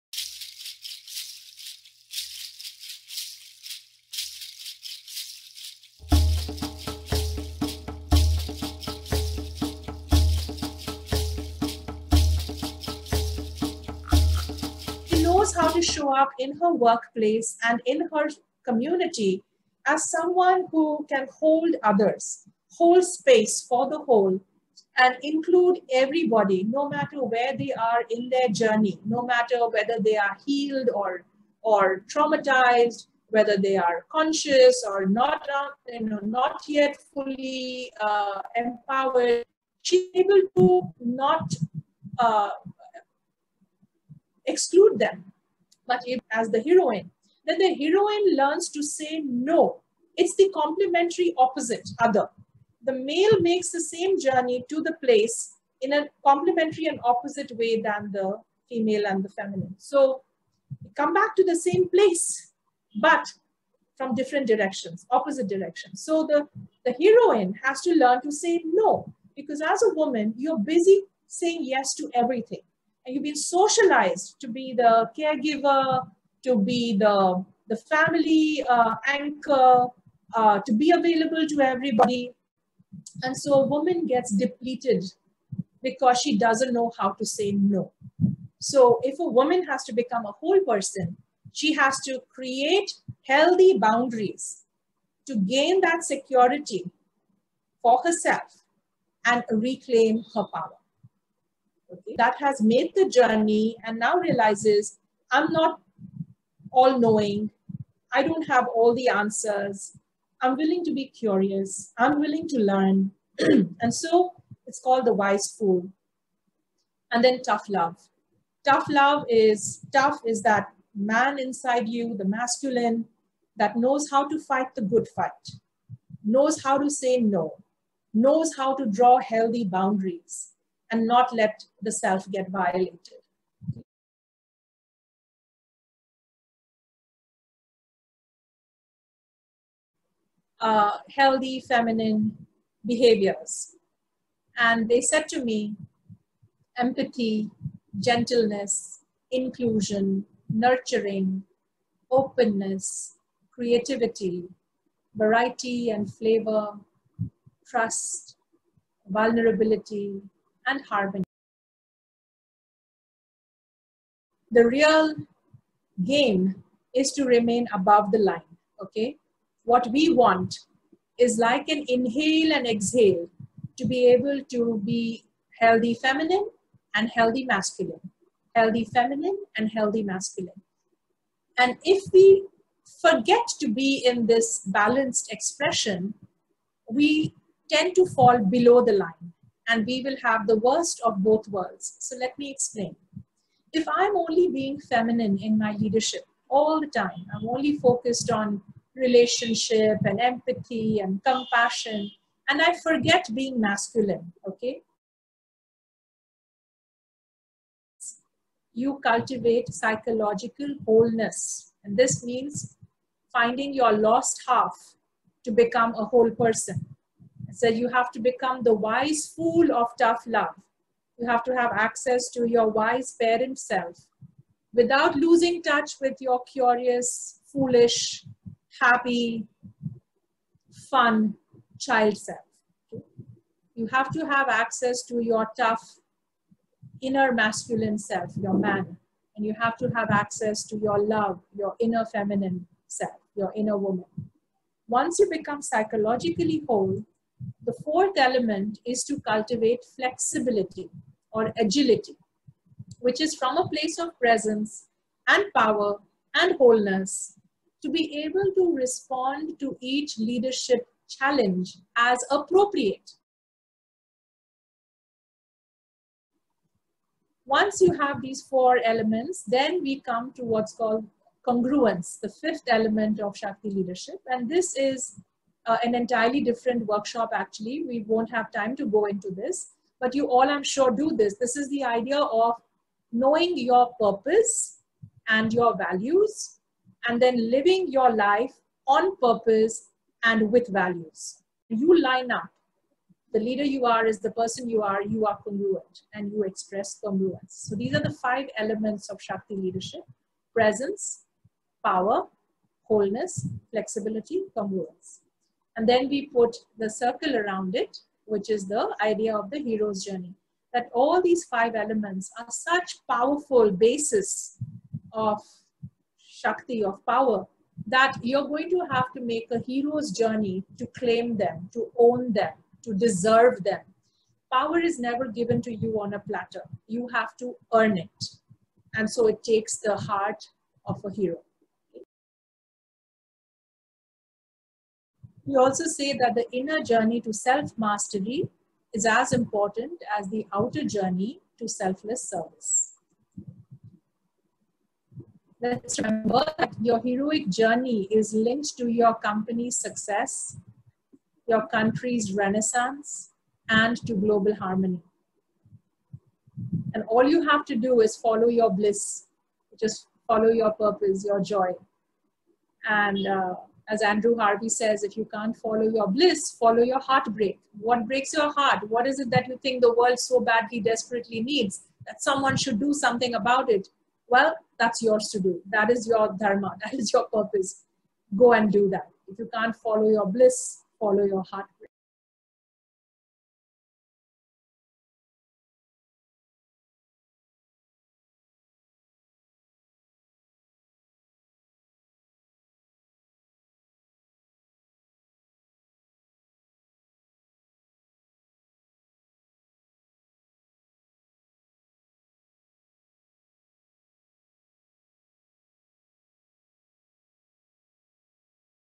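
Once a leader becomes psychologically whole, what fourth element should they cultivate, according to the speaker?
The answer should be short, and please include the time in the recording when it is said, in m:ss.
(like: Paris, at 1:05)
flexibility or agility, at 4:09.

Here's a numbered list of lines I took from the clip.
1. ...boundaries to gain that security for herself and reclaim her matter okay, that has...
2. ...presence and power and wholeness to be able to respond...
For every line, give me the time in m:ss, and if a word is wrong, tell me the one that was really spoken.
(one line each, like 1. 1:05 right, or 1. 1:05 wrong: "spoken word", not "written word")
1. 1:33 wrong: "power", not "matter"
2. 4:14 right.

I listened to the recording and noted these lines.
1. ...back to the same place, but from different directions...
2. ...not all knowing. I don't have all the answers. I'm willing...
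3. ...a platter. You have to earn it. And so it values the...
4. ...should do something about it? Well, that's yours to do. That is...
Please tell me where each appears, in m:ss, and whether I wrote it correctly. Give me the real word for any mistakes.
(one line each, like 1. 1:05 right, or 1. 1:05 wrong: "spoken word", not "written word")
1. 1:01 right
2. 1:45 right
3. 5:26 wrong: "takes", not "values"
4. 6:12 right.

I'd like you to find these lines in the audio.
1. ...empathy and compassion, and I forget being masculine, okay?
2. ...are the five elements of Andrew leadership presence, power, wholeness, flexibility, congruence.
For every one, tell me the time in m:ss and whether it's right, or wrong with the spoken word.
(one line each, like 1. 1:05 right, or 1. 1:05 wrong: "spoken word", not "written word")
1. 3:20 right
2. 4:57 wrong: "Shakti", not "Andrew".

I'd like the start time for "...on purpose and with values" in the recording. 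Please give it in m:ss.
4:48.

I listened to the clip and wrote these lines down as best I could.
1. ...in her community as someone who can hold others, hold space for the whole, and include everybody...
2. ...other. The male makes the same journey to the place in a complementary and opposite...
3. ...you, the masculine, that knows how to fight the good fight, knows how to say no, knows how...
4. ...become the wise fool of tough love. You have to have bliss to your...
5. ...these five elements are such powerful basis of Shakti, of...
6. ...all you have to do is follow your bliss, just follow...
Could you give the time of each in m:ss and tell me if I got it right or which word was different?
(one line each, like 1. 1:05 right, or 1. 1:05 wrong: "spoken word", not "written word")
1. 0:17 right
2. 0:51 right
3. 2:01 right
4. 3:38 wrong: "access", not "bliss"
5. 5:11 right
6. 5:57 right.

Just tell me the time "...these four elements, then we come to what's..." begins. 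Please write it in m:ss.
4:28.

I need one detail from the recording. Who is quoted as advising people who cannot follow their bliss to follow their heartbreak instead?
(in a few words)
Andrew Harvey.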